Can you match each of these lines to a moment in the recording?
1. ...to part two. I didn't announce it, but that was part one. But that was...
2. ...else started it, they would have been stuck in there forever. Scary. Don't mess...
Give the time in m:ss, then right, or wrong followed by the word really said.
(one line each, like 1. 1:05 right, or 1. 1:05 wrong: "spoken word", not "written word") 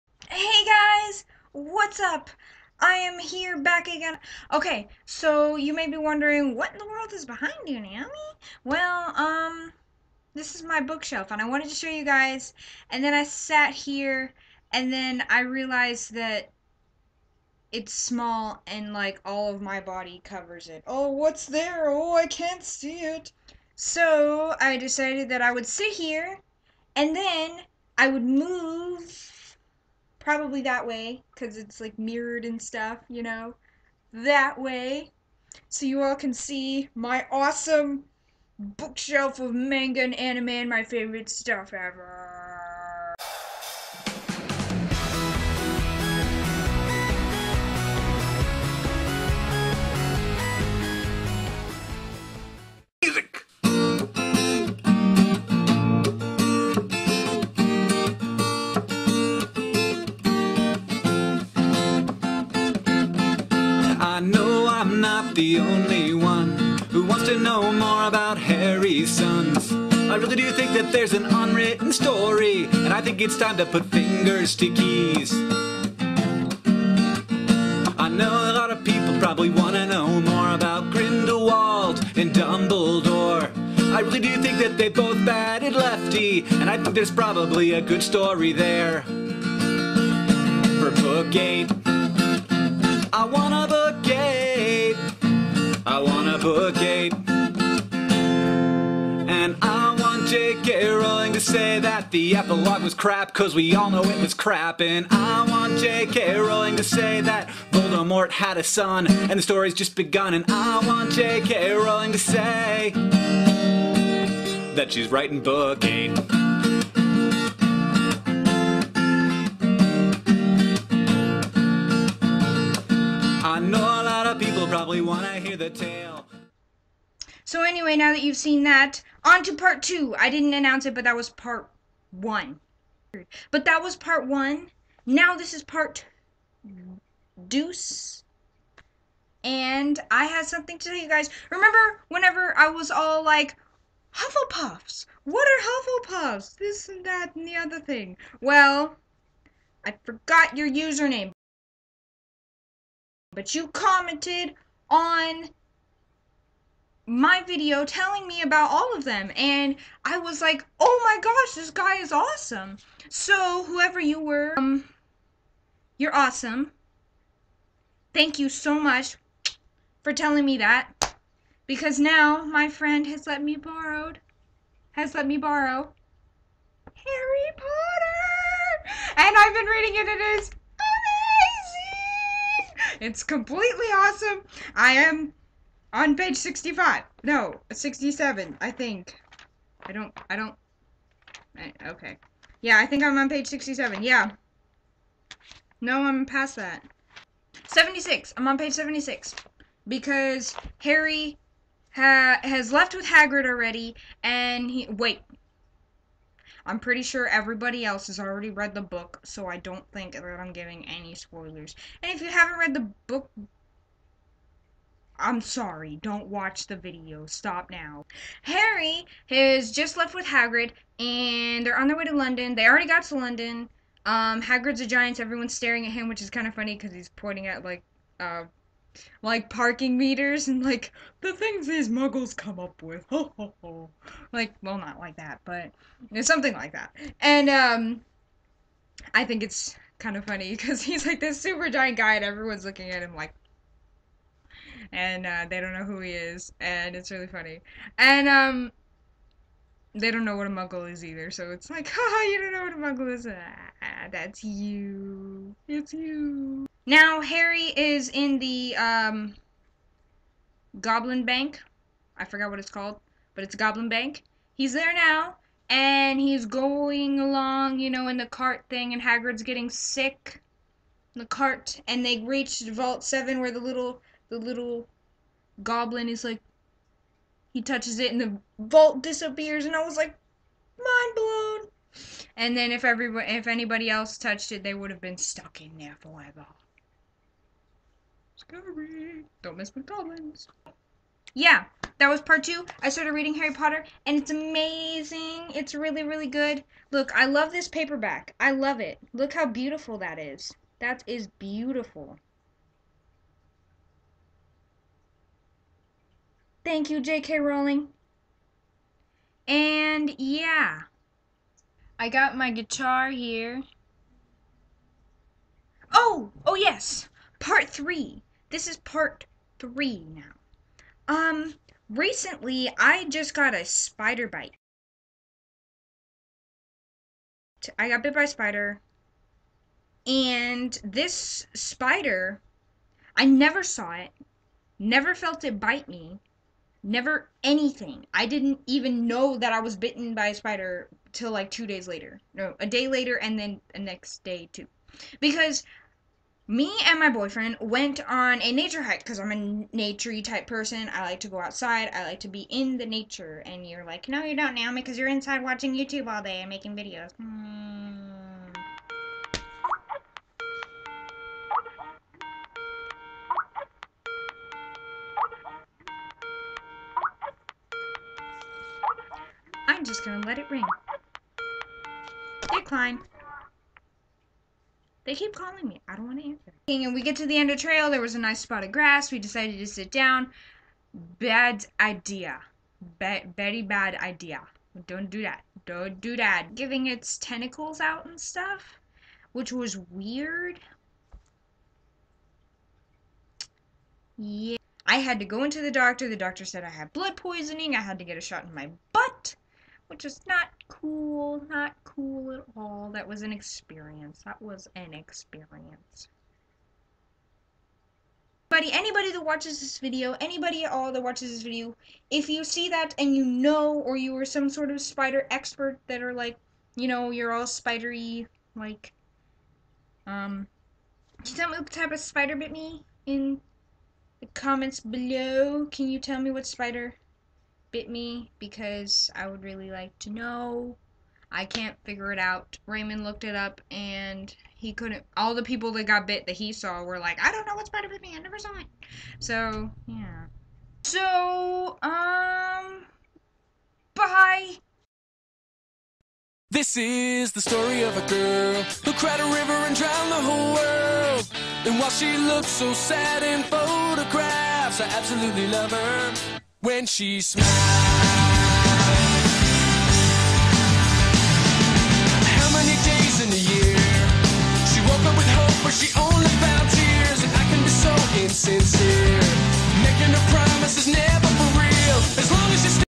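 1. 2:09 right
2. 4:43 wrong: "touched", not "started".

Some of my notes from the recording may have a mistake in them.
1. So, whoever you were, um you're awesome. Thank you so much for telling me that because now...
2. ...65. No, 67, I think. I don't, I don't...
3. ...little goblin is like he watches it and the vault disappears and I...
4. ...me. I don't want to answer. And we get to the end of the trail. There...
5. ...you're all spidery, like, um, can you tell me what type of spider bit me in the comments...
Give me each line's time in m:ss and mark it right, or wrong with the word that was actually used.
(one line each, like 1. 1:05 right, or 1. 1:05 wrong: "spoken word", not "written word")
1. 2:43 right
2. 3:06 right
3. 4:34 wrong: "touches", not "watches"
4. 6:15 right
5. 6:57 right.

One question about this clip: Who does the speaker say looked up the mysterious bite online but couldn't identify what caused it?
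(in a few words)
Raymond.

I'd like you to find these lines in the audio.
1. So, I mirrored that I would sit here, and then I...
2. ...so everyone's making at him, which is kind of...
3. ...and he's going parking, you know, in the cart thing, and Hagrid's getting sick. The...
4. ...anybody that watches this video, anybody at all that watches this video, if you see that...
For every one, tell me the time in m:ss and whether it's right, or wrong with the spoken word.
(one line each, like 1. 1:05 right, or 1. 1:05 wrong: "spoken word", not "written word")
1. 0:23 wrong: "decided", not "mirrored"
2. 3:45 wrong: "staring", not "making"
3. 4:25 wrong: "along", not "parking"
4. 6:48 right.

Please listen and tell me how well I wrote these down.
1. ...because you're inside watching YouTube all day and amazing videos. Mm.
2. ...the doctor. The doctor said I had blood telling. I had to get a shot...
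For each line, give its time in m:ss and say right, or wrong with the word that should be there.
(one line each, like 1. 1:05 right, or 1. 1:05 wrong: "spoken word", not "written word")
1. 5:54 wrong: "making", not "amazing"
2. 6:35 wrong: "poisoning", not "telling".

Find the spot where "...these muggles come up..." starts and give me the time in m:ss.
3:51.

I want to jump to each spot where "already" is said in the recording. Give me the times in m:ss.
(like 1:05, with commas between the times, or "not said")
3:23, 3:28, 3:42.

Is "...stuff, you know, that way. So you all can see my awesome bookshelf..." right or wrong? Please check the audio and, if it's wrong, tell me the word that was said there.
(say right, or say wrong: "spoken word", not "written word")
right.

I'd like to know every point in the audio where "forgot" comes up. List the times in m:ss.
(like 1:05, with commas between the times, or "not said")
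2:30, 4:22.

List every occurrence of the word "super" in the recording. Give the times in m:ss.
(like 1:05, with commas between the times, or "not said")
4:01.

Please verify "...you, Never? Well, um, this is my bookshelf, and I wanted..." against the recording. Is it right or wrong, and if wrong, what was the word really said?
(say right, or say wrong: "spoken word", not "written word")
wrong: "Naomi", not "Never".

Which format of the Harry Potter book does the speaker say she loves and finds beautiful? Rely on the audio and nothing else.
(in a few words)
paperback.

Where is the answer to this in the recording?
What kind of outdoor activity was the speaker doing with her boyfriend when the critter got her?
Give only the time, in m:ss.
5:48.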